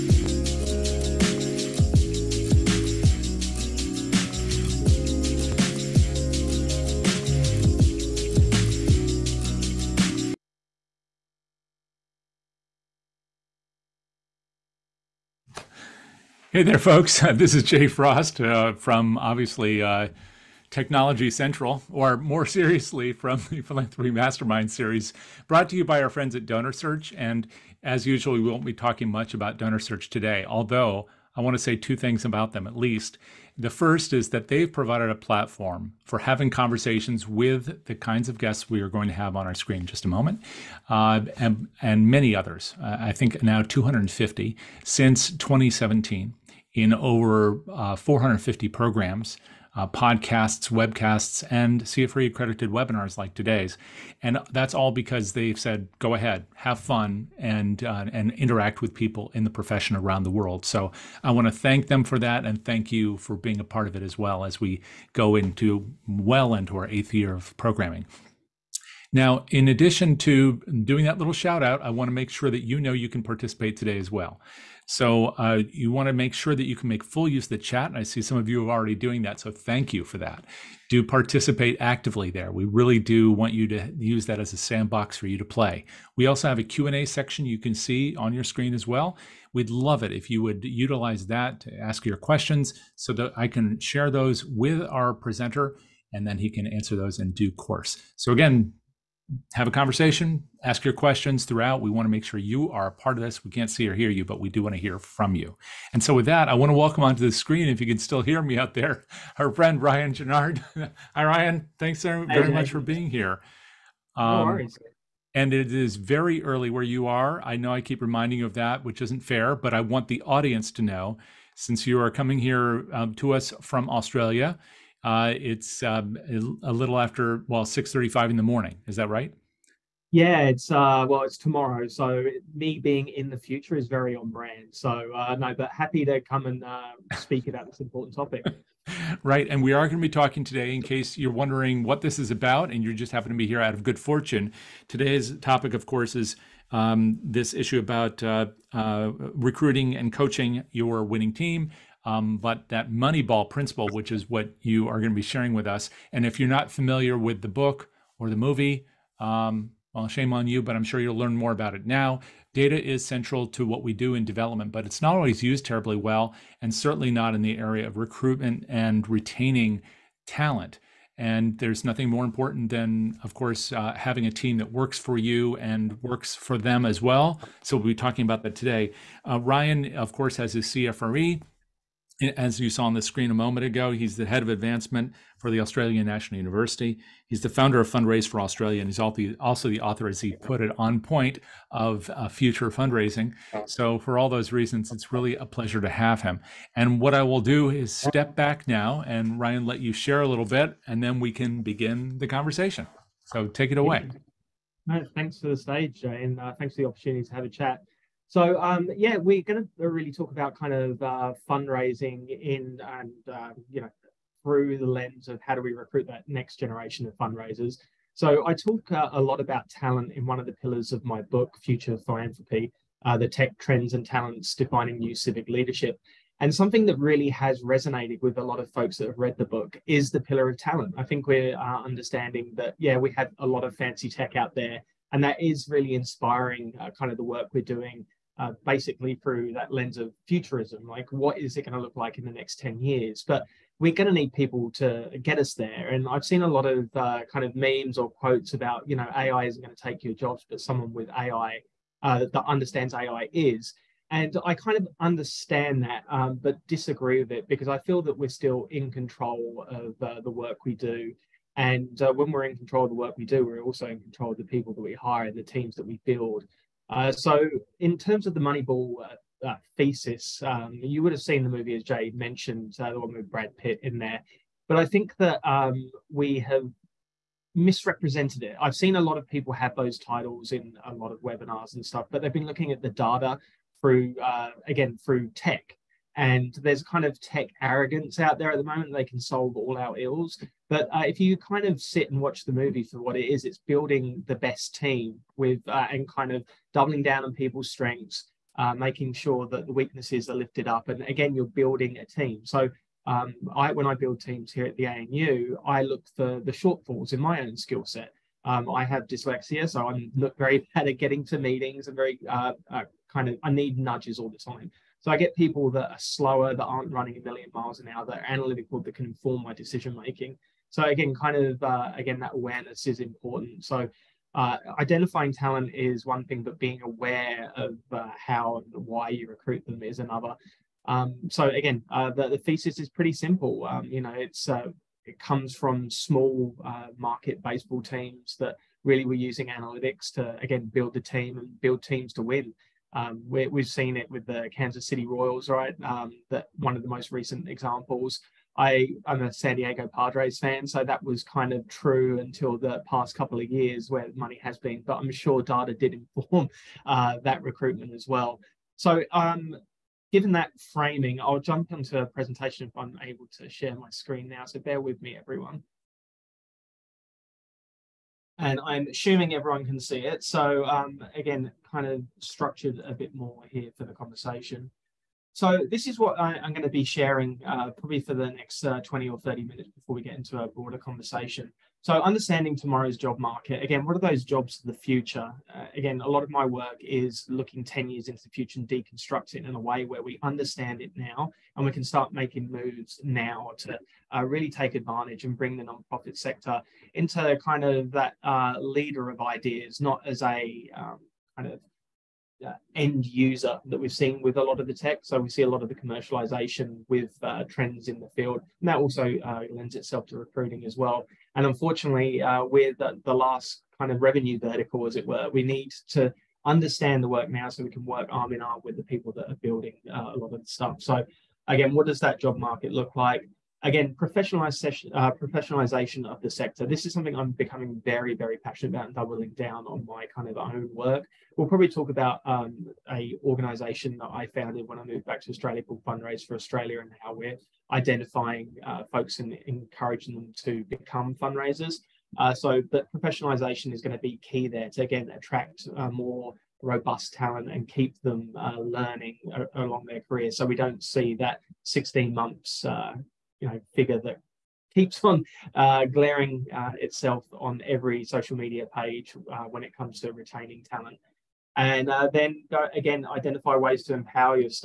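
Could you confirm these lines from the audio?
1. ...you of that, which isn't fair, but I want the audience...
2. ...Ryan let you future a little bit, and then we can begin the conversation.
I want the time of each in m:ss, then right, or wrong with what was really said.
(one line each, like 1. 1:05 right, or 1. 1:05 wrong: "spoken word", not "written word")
1. 1:58 right
2. 3:19 wrong: "share", not "future".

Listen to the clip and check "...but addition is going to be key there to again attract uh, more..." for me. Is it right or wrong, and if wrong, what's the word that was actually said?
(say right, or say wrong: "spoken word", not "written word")
wrong: "professionalization", not "addition".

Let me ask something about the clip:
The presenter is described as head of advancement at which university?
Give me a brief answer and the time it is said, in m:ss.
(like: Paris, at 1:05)
Australian National University, at 3:05.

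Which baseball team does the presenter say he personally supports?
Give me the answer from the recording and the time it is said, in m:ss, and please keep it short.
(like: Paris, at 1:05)
San Diego Padres, at 5:49.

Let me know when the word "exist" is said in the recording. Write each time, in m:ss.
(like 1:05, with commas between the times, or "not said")
not said.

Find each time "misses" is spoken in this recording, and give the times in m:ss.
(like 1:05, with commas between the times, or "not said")
not said.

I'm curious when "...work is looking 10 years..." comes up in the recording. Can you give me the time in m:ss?
6:26.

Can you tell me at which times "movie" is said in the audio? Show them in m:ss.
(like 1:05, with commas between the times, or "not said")
2:38, 4:31, 4:52.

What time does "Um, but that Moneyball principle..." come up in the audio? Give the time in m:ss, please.
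2:32.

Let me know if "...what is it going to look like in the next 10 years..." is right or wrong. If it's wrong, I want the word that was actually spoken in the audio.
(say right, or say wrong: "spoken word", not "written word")
right.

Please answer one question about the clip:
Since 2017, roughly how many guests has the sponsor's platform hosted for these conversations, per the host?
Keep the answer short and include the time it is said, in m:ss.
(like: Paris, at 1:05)
250, at 0:43.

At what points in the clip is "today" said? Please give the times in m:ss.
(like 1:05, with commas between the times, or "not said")
0:30, 0:53, 1:13, 2:20, 2:24, 2:58.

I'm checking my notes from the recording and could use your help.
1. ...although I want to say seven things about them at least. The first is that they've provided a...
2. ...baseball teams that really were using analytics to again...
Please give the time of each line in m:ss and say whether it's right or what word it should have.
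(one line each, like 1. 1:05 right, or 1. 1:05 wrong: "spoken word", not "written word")
1. 0:30 wrong: "two", not "seven"
2. 5:37 right.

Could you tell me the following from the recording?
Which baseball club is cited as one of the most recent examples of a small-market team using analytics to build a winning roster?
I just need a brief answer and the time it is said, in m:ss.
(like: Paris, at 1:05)
Kansas City Royals, at 5:44.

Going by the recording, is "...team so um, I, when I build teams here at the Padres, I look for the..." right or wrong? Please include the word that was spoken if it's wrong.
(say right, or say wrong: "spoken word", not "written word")
wrong: "ANU", not "Padres".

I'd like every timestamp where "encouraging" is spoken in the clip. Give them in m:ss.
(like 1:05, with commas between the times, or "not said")
7:19.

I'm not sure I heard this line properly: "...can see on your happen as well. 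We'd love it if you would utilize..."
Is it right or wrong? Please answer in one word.
wrong.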